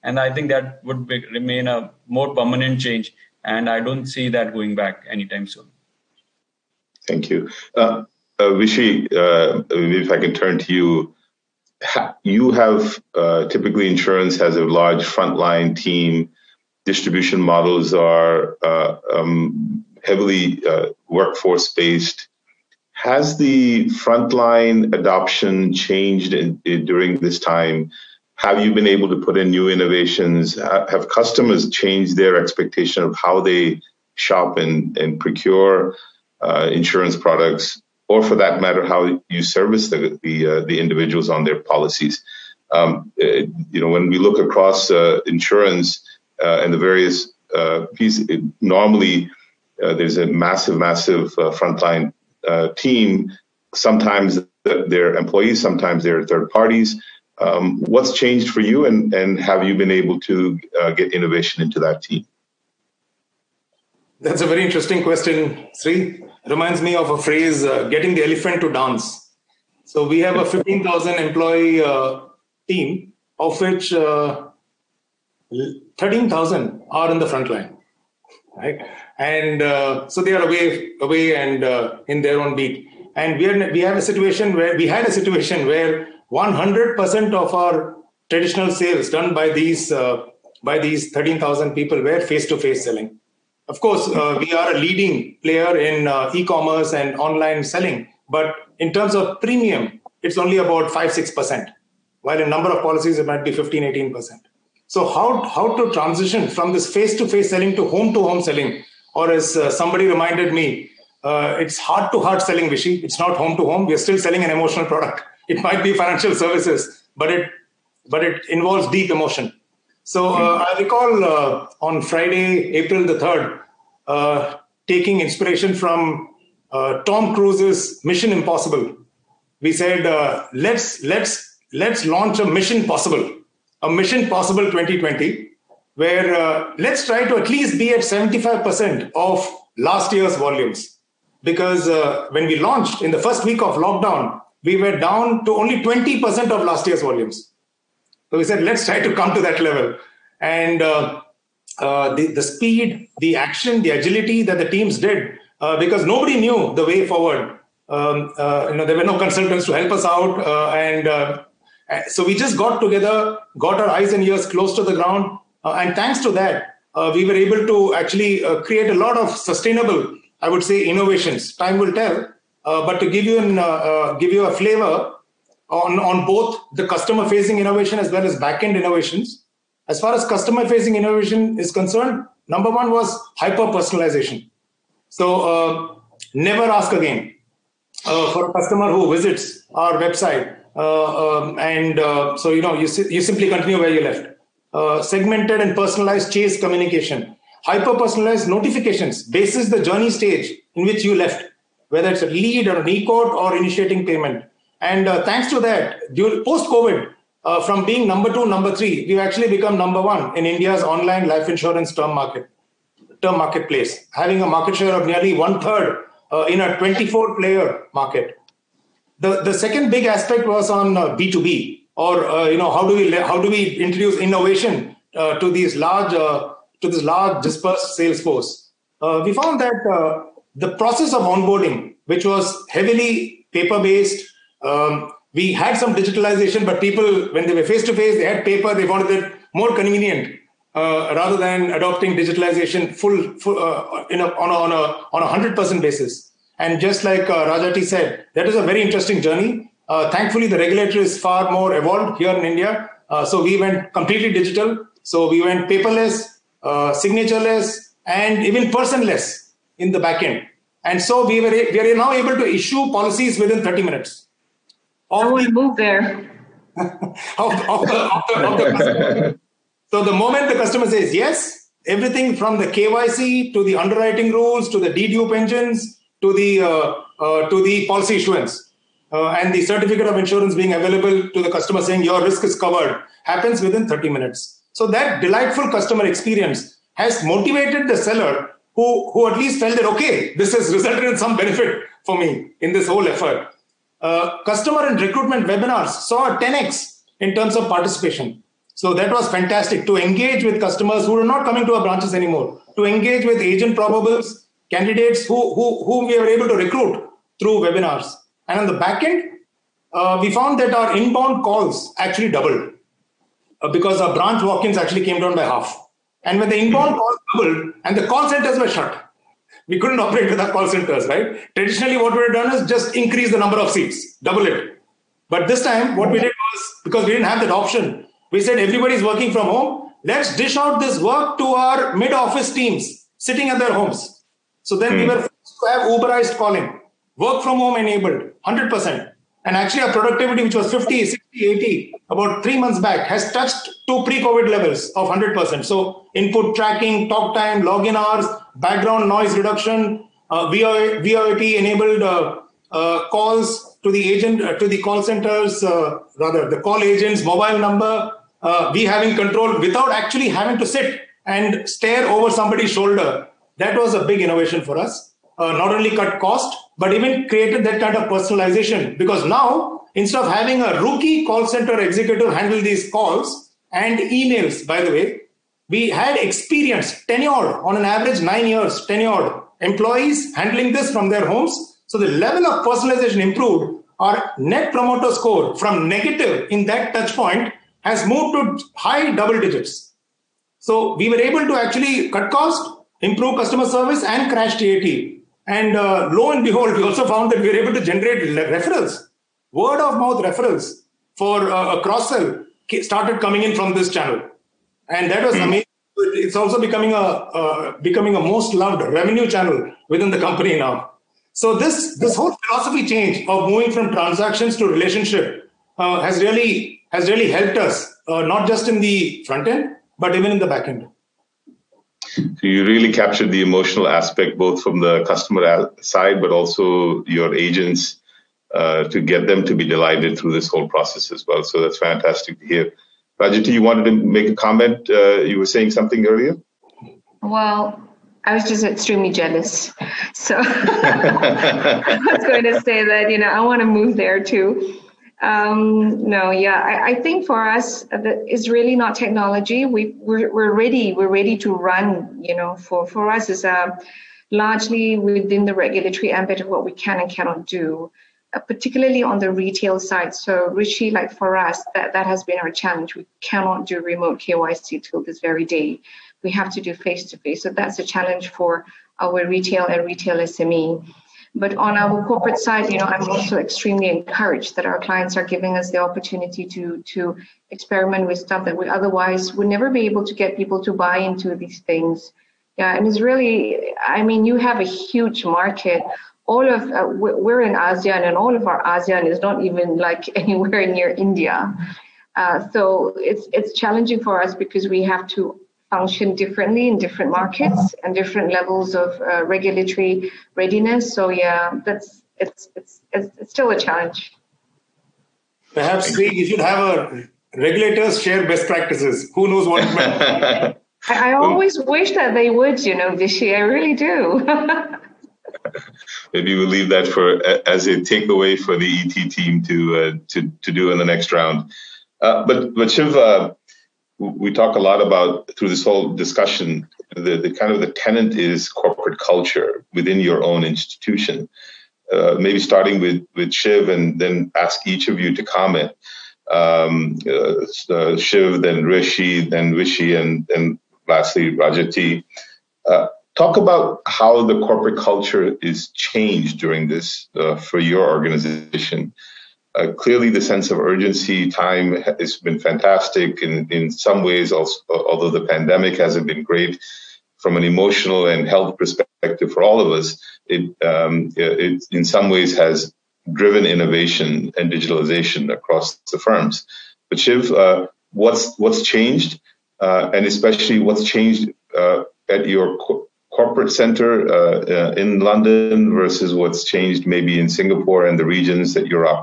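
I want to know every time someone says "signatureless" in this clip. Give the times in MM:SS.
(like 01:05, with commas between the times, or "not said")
04:16.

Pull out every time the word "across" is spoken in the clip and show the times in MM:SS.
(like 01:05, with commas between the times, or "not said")
00:44, 09:25.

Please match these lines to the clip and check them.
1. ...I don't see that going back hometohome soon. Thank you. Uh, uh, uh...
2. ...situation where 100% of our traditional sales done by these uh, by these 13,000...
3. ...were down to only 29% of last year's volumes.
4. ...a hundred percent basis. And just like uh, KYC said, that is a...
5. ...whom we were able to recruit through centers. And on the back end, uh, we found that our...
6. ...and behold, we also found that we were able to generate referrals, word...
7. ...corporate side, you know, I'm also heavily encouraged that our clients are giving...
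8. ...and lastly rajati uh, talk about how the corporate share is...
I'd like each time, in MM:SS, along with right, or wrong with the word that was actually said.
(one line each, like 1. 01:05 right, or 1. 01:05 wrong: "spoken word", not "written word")
1. 00:03 wrong: "anytime", not "hometohome"
2. 01:25 right
3. 02:24 wrong: "20", not "29"
4. 04:05 wrong: "Rajati", not "KYC"
5. 05:05 wrong: "webinars", not "centers"
6. 06:36 right
7. 07:52 wrong: "extremely", not "heavily"
8. 09:00 wrong: "culture", not "share".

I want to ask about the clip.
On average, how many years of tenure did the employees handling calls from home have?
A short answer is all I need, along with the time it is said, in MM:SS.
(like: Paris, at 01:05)
9 years, at 06:18.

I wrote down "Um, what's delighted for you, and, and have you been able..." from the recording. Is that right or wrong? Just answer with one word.
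wrong.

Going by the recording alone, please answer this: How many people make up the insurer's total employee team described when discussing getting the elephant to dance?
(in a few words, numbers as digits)
15,000.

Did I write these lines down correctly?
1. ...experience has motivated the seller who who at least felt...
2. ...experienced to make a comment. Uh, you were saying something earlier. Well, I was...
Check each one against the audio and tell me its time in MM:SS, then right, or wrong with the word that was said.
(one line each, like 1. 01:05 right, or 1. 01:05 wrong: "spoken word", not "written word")
1. 04:46 right
2. 07:13 wrong: "wanted", not "experienced".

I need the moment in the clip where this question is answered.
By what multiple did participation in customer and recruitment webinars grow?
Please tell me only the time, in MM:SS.
04:56.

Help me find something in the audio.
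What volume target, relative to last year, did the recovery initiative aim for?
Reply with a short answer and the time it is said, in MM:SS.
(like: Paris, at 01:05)
75%, at 02:17.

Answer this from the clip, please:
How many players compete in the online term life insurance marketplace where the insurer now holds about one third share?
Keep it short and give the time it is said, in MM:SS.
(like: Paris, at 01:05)
24, at 03:36.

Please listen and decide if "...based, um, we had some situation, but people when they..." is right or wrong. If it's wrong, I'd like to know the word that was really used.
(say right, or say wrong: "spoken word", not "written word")
wrong: "digitalization", not "situation".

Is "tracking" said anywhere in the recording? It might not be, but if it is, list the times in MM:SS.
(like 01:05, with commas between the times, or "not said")
05:46.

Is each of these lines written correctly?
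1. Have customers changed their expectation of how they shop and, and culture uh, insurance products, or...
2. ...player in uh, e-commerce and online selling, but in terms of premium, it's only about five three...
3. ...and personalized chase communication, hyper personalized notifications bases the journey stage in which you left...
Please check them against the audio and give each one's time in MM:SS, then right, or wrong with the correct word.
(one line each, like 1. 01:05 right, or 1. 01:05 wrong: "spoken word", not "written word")
1. 00:30 wrong: "procure", not "culture"
2. 01:35 wrong: "six", not "three"
3. 03:15 right.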